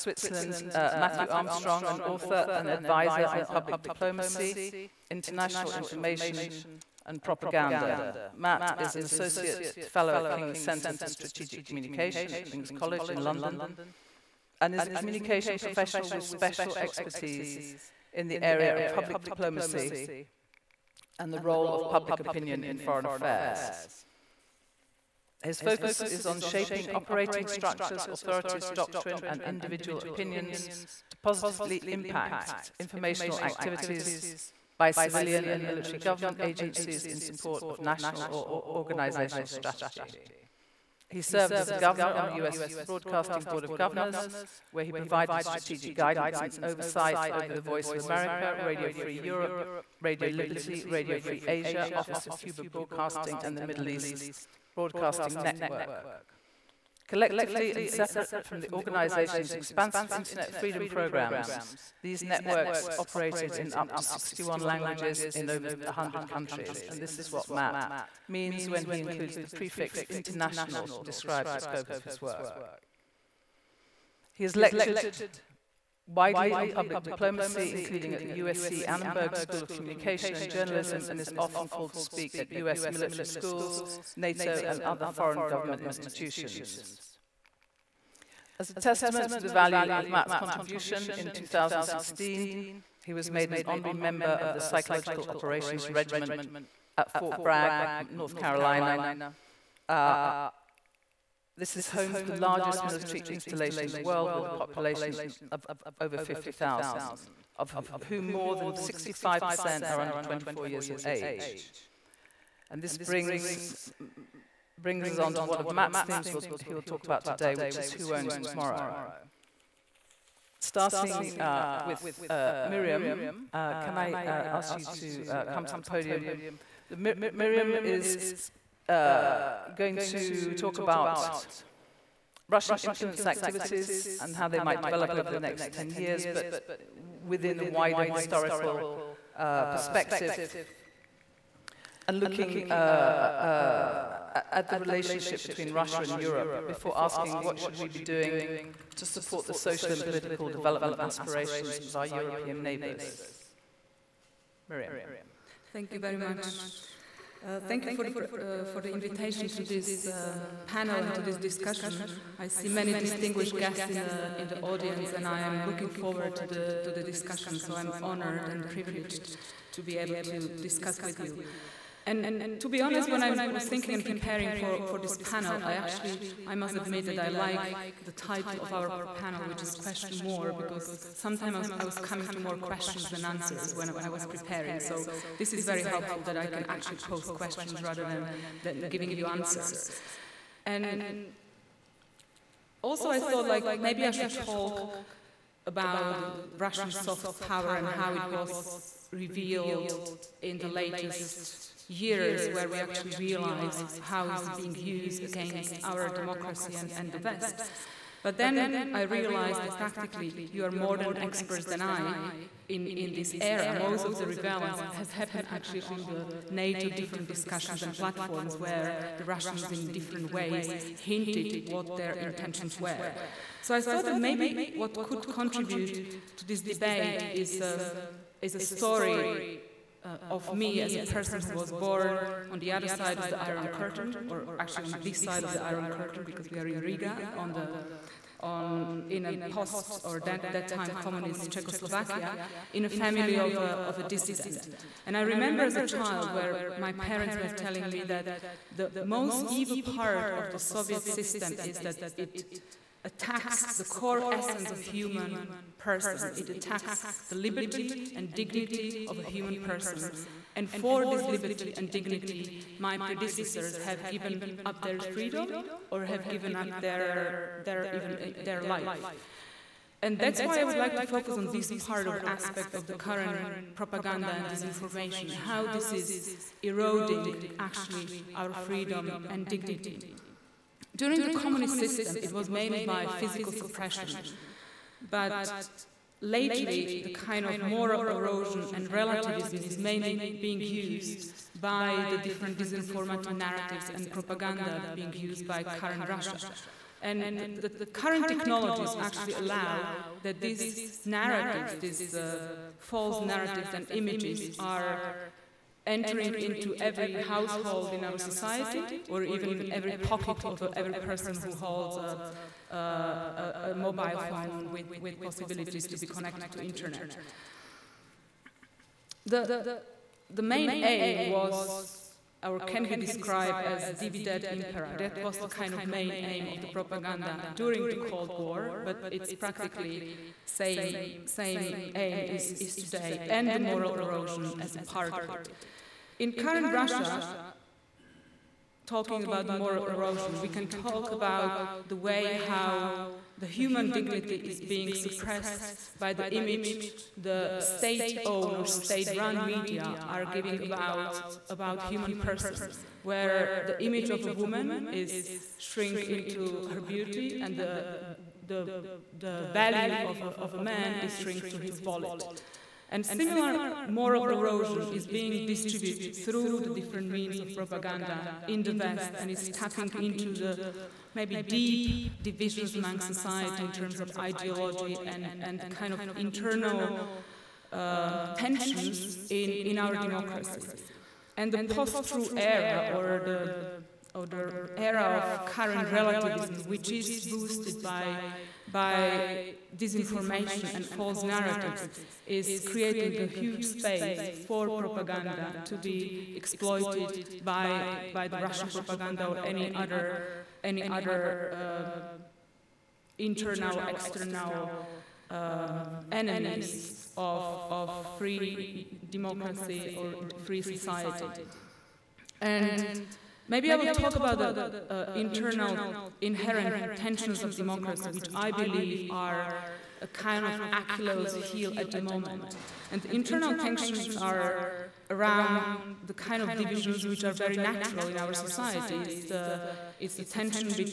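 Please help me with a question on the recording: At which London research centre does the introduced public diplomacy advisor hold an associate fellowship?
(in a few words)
King's Centre for Strategic Communication.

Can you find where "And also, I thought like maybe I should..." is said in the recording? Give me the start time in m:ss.
3:10.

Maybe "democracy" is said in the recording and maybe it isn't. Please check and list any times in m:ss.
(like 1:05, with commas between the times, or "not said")
3:26, 6:19, 6:49, 6:57.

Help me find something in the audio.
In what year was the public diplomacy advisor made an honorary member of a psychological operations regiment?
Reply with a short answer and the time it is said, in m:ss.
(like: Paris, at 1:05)
2016, at 1:31.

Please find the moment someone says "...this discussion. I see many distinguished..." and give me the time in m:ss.
2:41.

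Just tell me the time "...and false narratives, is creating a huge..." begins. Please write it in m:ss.
6:30.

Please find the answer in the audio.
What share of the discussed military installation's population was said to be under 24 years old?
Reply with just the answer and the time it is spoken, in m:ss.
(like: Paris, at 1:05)
More than 65%, at 1:48.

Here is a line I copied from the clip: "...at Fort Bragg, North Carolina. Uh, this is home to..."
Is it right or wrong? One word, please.
right.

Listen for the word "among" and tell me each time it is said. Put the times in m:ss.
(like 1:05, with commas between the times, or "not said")
6:12.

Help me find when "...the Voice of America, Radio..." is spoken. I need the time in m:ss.
0:47.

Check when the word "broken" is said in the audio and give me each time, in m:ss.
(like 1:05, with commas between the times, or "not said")
not said.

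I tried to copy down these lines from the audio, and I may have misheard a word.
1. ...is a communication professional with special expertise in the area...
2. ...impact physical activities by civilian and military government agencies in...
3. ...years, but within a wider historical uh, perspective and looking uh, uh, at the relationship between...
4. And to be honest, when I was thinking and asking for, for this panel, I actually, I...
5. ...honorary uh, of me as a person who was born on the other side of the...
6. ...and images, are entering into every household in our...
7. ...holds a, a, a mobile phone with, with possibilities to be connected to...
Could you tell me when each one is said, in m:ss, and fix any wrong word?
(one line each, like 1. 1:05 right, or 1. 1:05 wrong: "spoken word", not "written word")
1. 0:14 right
2. 0:31 wrong: "informational", not "physical"
3. 2:15 right
4. 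2:52 wrong: "preparing", not "asking"
5. 3:48 wrong: "story", not "honorary"
6. 5:03 right
7. 5:11 right.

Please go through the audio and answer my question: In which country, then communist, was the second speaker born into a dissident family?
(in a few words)
Czechoslovakia.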